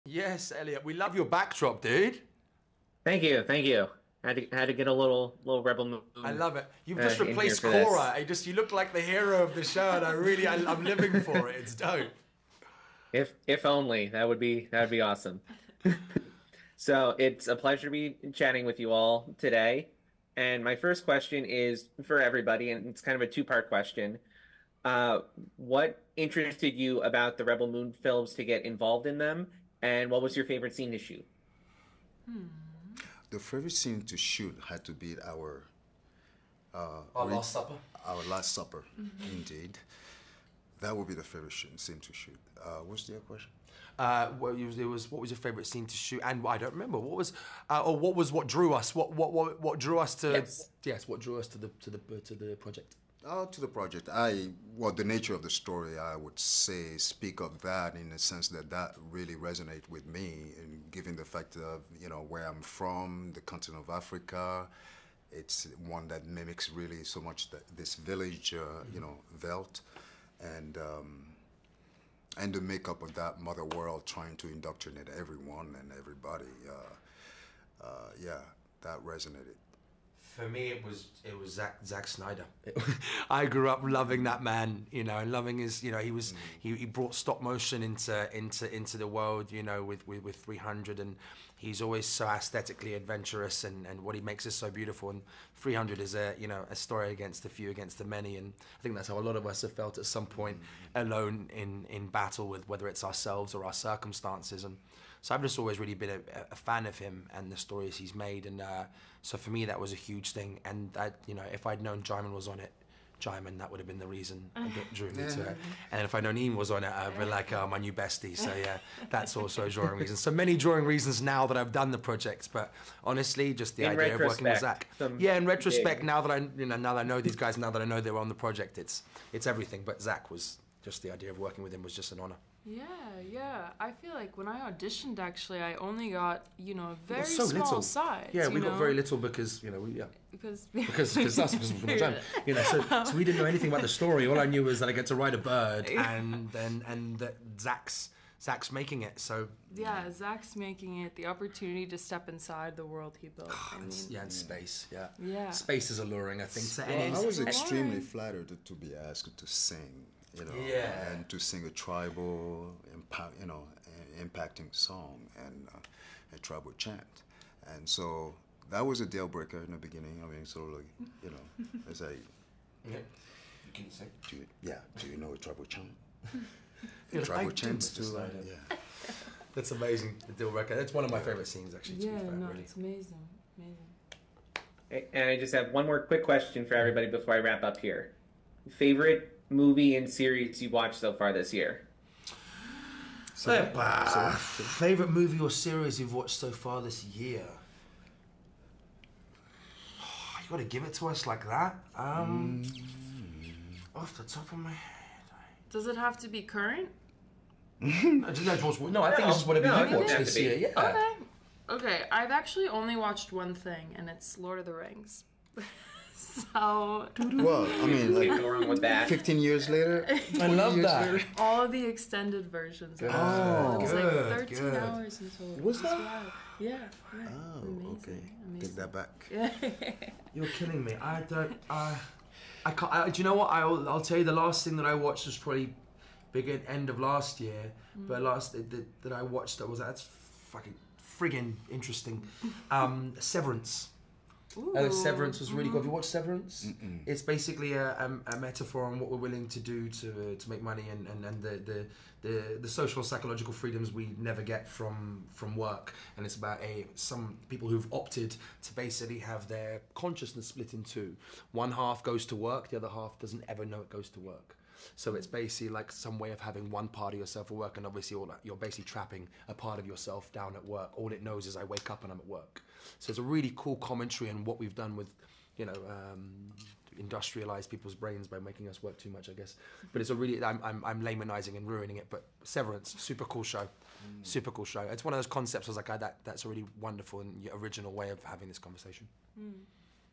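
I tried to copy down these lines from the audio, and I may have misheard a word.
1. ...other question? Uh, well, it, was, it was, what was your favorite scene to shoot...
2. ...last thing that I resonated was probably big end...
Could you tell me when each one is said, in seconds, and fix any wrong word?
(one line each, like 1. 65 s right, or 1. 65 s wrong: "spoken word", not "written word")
1. 43 s right
2. 234 s wrong: "watched", not "resonated".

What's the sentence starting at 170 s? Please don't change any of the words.
I mean, sort of like, you know, it's like, yeah.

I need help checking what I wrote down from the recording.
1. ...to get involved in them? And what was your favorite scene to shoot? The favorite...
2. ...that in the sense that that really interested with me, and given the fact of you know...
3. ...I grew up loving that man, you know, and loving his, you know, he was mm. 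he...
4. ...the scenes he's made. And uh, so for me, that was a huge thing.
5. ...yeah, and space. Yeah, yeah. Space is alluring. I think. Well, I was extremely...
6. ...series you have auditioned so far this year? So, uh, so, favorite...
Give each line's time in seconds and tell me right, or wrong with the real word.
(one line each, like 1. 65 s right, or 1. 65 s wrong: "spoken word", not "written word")
1. 28 s right
2. 57 s wrong: "resonated", not "interested"
3. 83 s right
4. 107 s wrong: "stories", not "scenes"
5. 154 s right
6. 190 s wrong: "watched", not "auditioned".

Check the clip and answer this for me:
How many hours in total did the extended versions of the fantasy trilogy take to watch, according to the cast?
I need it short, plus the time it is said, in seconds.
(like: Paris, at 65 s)
13, at 224 s.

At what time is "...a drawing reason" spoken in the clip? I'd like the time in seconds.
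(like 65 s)
119 s.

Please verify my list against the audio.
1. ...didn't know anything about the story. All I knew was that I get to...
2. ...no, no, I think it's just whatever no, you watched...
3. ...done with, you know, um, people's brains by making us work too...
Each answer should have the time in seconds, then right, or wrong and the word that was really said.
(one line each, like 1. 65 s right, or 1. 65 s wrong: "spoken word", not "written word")
1. 143 s right
2. 207 s right
3. 274 s right.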